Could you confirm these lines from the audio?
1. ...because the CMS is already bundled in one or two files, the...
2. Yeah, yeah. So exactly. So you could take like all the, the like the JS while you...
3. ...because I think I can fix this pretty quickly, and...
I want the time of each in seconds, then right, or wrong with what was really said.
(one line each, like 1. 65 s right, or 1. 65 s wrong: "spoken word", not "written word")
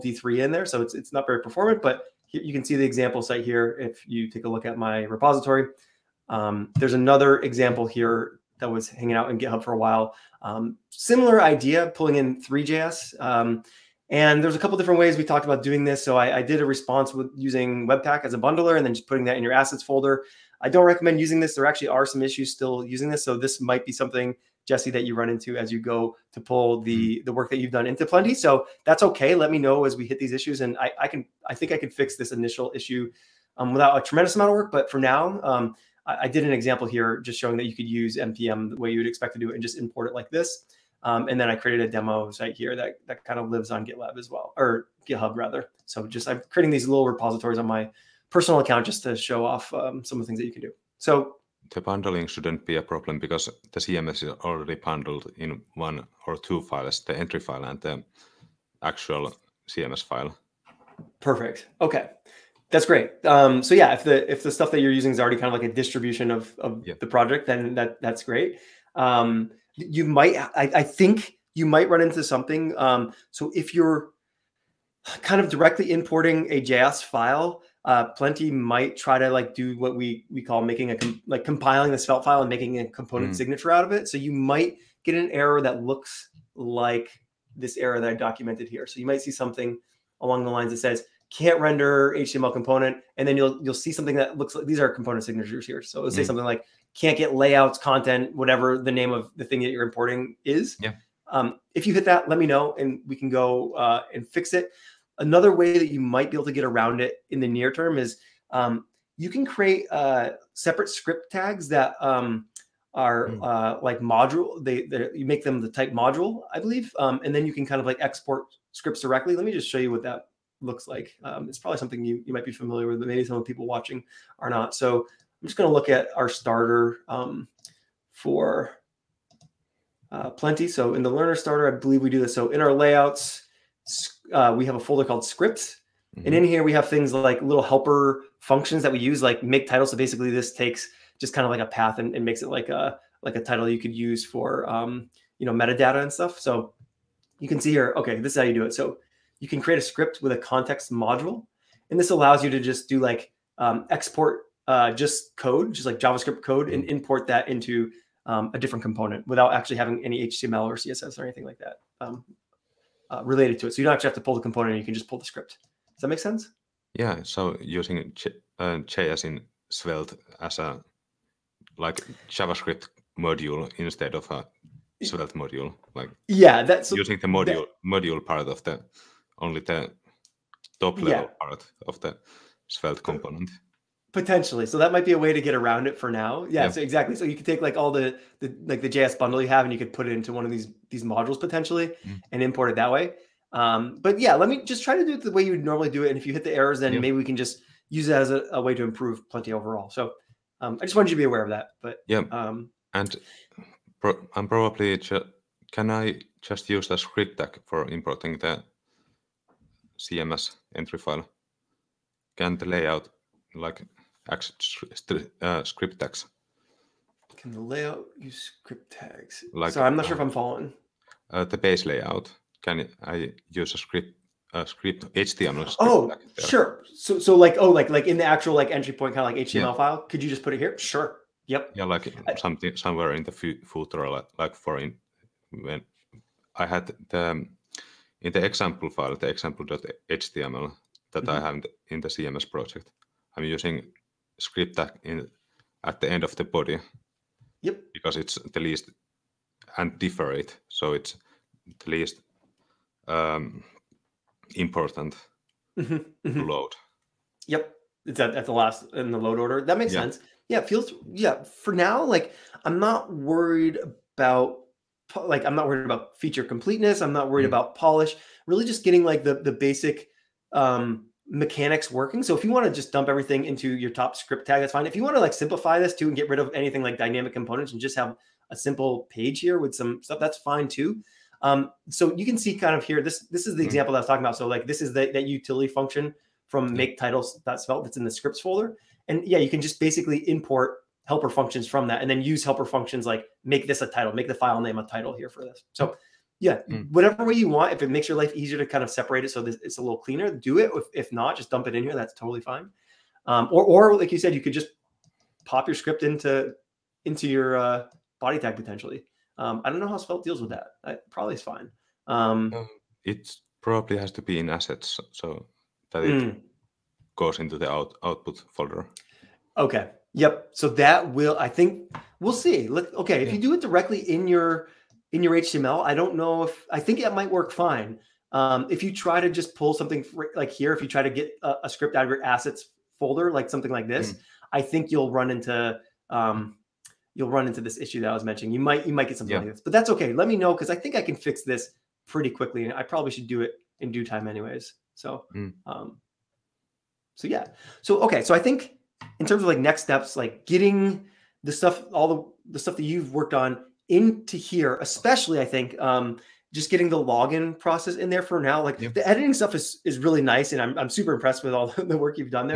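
1. 53 s right
2. 186 s wrong: "bundle", not "while"
3. 340 s right.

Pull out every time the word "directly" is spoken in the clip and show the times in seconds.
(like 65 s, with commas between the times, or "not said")
75 s, 119 s, 323 s.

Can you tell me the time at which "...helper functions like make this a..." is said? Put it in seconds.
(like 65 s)
292 s.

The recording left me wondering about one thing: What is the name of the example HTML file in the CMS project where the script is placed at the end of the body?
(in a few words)
example.html.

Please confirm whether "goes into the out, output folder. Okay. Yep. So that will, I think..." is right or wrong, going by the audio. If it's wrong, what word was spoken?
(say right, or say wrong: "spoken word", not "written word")
right.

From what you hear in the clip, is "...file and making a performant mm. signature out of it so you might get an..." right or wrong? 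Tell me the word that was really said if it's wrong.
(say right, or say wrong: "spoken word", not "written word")
wrong: "component", not "performant".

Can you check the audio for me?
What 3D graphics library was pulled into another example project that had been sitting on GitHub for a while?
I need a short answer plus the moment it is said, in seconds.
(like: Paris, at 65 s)
3JS, at 12 s.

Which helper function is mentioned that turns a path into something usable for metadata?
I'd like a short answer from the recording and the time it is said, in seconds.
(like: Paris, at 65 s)
make title, at 139 s.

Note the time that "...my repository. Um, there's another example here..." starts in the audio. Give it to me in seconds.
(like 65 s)
4 s.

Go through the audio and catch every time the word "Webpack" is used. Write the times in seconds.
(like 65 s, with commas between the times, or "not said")
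17 s.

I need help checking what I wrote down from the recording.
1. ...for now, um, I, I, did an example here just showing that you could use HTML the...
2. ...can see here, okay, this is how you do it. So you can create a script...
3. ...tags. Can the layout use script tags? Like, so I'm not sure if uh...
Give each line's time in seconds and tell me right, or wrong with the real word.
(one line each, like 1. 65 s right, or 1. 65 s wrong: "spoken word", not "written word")
1. 34 s wrong: "NPM", not "HTML"
2. 147 s right
3. 215 s right.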